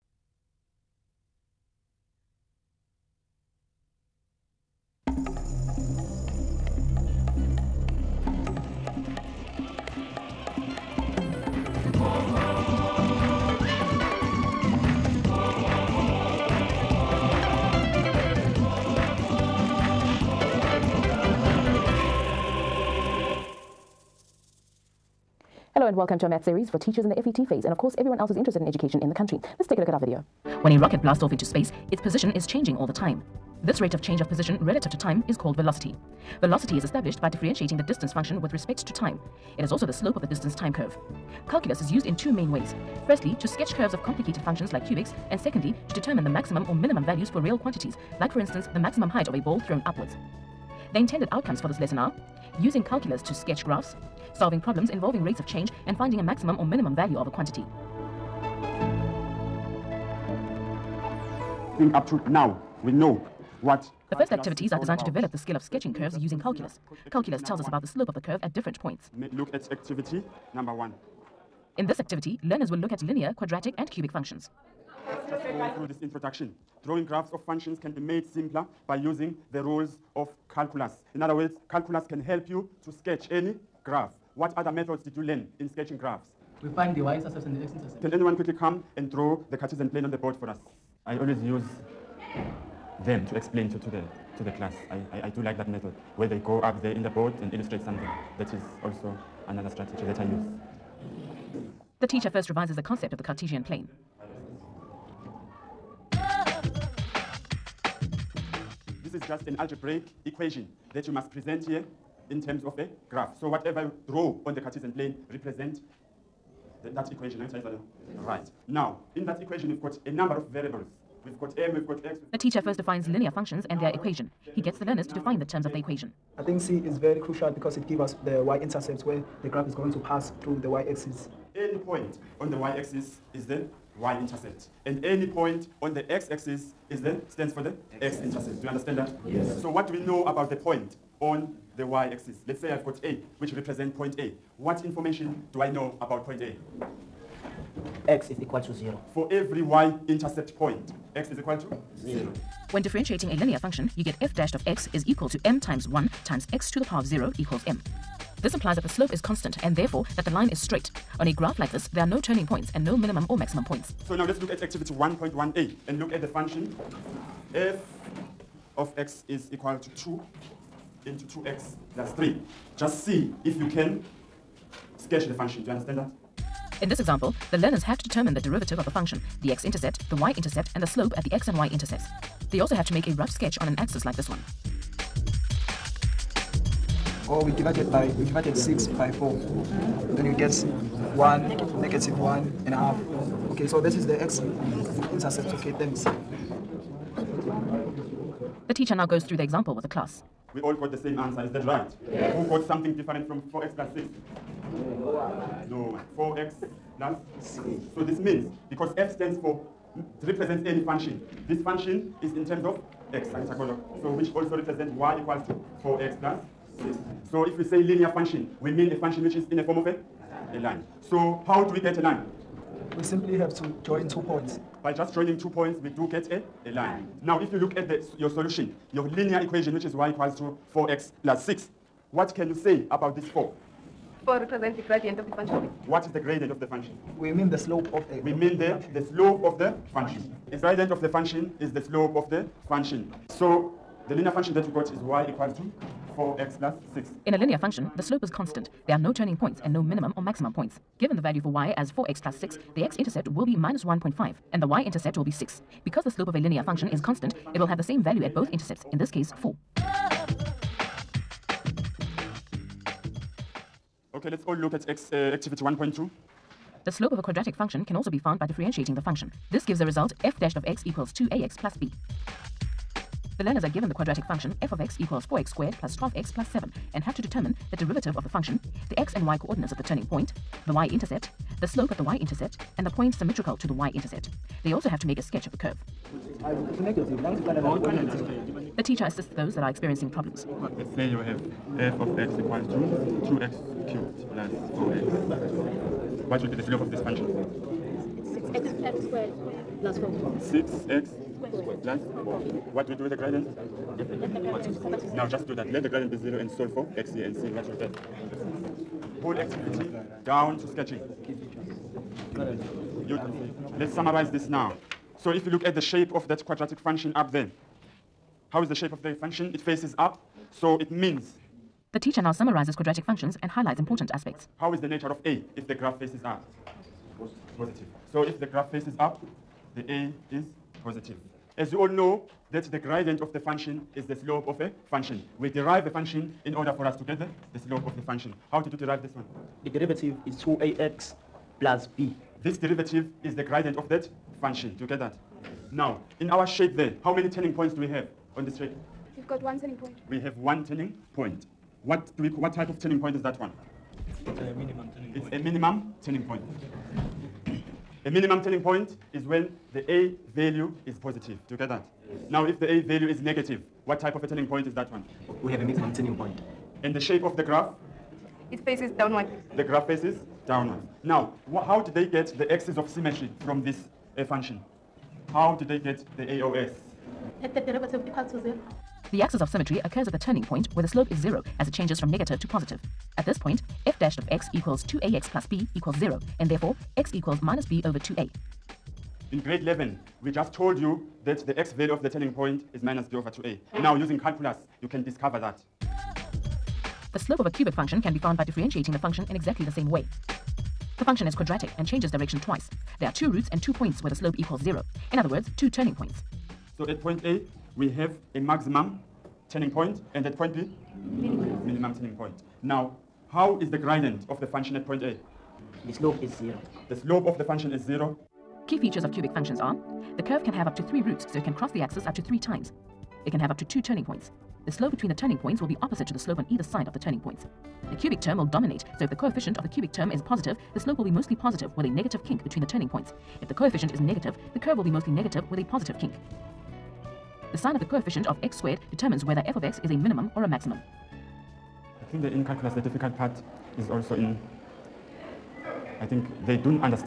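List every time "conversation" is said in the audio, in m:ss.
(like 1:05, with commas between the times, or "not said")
not said.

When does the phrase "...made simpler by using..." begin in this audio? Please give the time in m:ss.
1:17.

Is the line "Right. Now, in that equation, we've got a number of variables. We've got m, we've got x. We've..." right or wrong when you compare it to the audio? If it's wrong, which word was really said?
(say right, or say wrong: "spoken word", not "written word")
right.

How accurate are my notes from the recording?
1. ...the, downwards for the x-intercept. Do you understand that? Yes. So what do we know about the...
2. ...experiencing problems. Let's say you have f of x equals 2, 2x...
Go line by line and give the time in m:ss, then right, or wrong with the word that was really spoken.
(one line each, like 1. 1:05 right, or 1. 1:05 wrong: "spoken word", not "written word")
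1. 2:17 wrong: "stands", not "downwards"
2. 4:49 right.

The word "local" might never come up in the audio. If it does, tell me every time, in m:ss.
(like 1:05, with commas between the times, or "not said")
not said.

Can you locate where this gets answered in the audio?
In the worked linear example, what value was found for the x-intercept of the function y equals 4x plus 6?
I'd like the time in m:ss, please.
4:13.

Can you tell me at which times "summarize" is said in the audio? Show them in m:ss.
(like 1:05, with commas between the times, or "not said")
5:13, 5:22.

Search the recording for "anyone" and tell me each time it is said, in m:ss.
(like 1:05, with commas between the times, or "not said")
1:28.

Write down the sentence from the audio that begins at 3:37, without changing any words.
So if we say linear function, we mean a function which is in the form of a, a line.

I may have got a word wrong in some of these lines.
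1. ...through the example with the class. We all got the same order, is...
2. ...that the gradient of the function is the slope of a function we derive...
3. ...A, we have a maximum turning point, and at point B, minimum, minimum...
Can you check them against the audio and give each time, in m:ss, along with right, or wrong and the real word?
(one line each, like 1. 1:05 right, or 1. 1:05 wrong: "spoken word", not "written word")
1. 3:19 wrong: "answer", not "order"
2. 5:32 right
3. 6:47 right.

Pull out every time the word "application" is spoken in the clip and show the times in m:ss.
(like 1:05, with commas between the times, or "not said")
not said.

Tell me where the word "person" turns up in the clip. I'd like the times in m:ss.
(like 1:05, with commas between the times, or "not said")
not said.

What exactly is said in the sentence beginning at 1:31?
I always use them to explain to, to, the, to the class.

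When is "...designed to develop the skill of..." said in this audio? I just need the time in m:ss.
1:04.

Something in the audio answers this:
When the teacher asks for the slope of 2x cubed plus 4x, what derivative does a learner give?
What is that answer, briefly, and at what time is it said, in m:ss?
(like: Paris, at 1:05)
6x² + 4, at 5:00.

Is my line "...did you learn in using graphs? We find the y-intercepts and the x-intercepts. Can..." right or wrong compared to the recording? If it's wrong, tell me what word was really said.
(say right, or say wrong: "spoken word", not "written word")
wrong: "sketching", not "using".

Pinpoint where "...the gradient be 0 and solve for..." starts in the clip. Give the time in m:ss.
5:05.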